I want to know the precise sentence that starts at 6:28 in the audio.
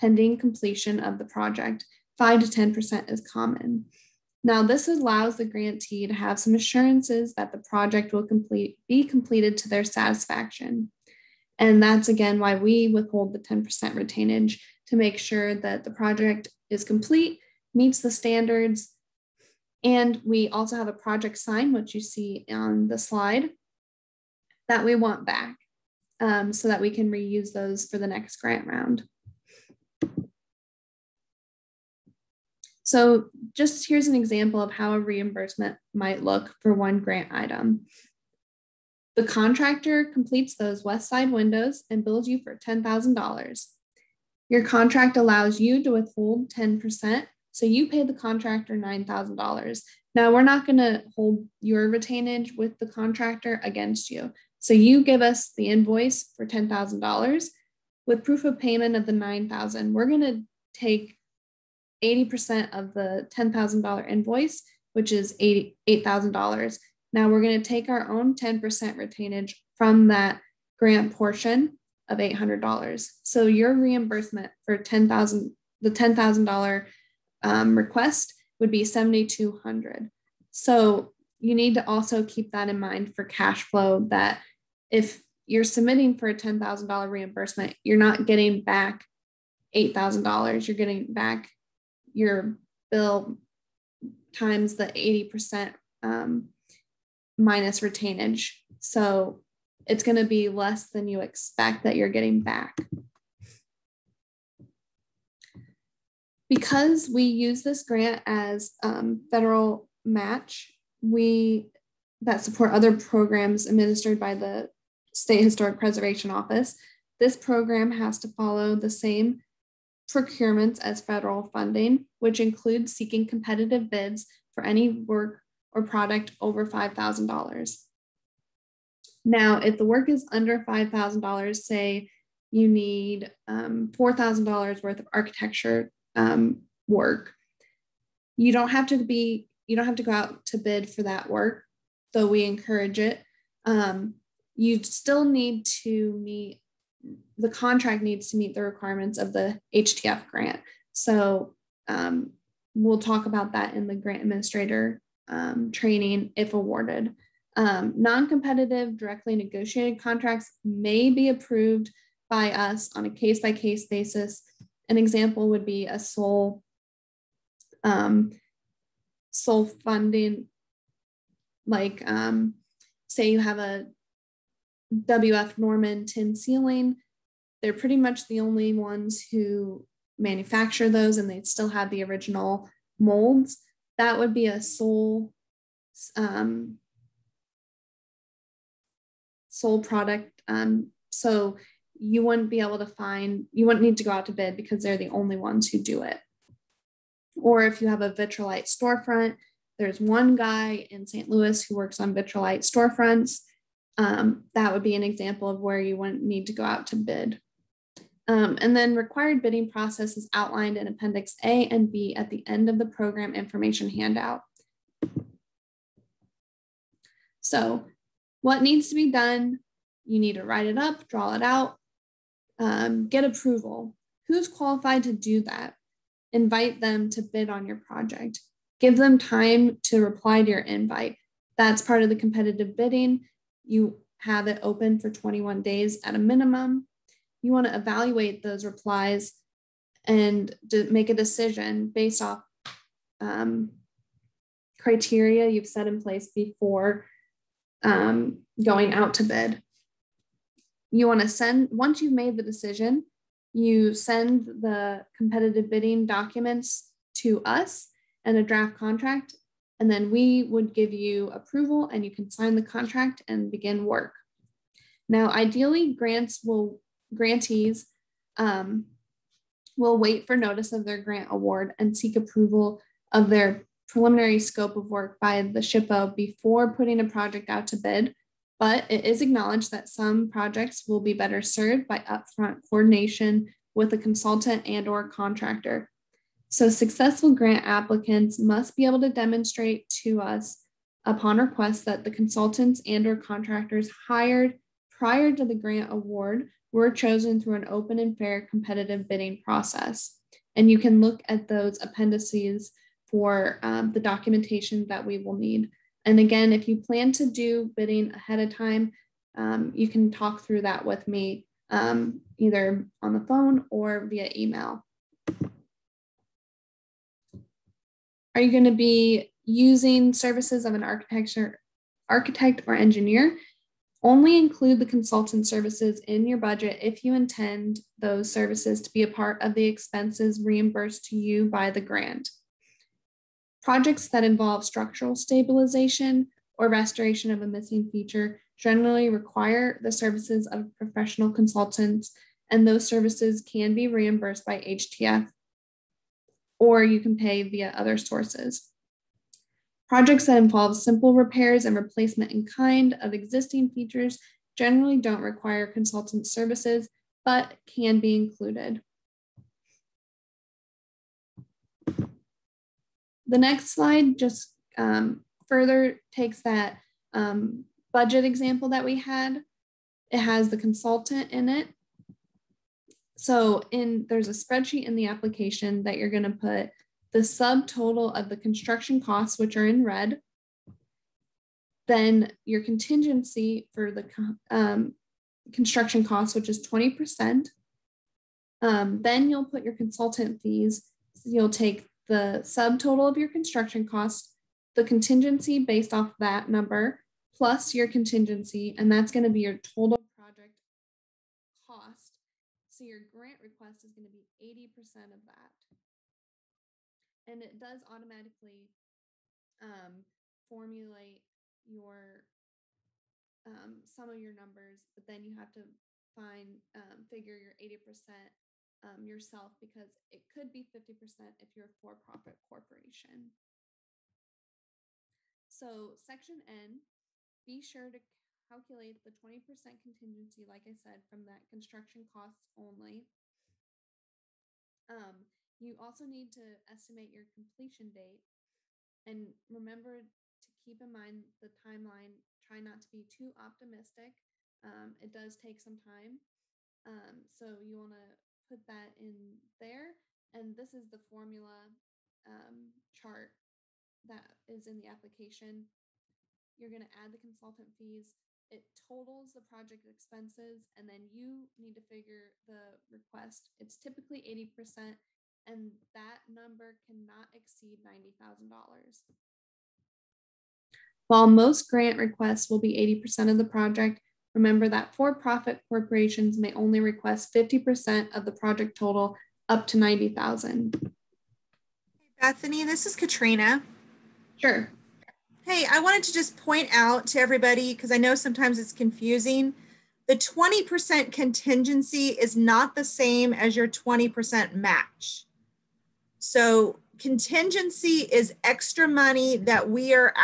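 Um, then you'll put your consultant fees.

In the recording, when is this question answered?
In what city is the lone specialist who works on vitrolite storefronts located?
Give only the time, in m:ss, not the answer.
3:21.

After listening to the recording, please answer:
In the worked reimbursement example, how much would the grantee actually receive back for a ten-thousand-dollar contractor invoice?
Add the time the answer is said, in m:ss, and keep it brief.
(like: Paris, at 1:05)
$7,200, at 1:18.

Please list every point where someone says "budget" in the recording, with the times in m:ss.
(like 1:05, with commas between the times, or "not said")
5:26, 6:07.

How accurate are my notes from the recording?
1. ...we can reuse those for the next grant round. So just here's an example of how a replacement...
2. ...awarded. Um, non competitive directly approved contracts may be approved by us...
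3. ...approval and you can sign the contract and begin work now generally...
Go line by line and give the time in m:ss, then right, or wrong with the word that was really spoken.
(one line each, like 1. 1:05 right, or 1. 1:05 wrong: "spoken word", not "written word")
1. 0:26 wrong: "reimbursement", not "replacement"
2. 2:36 wrong: "negotiated", not "approved"
3. 4:21 wrong: "ideally", not "generally".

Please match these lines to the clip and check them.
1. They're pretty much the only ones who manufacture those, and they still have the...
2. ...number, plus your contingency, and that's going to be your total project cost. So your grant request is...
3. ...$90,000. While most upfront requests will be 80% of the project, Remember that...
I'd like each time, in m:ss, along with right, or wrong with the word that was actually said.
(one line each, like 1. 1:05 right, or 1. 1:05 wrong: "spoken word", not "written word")
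1. 2:57 right
2. 6:36 right
3. 7:47 wrong: "grant", not "upfront".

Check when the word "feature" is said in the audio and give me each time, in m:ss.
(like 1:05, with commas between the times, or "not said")
5:37, 5:53.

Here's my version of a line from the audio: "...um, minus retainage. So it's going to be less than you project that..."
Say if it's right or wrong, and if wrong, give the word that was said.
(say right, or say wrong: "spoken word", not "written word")
wrong: "expect", not "project".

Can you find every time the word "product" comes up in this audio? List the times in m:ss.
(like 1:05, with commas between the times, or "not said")
2:05, 3:09.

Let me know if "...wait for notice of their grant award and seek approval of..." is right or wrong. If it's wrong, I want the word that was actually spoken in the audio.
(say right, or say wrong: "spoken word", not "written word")
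right.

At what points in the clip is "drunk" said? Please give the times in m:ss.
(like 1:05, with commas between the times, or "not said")
not said.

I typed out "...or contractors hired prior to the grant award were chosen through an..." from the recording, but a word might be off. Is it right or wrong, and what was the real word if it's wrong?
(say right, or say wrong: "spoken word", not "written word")
right.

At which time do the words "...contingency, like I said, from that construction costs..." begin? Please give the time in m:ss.
7:09.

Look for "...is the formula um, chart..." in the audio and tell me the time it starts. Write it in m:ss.
7:30.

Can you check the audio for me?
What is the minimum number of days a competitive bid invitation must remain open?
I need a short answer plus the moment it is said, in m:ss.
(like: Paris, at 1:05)
21 days, at 3:55.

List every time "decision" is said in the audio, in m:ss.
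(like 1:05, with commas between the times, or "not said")
4:01, 4:12.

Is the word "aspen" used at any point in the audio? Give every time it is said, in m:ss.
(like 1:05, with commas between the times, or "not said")
not said.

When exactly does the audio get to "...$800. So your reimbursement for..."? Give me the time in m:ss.
1:12.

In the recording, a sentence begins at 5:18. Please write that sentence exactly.
Are you going to be using services of an architecture architect or engineer?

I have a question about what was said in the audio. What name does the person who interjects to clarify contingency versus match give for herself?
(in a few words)
Katrina.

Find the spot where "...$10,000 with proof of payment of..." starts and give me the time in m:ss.
0:56.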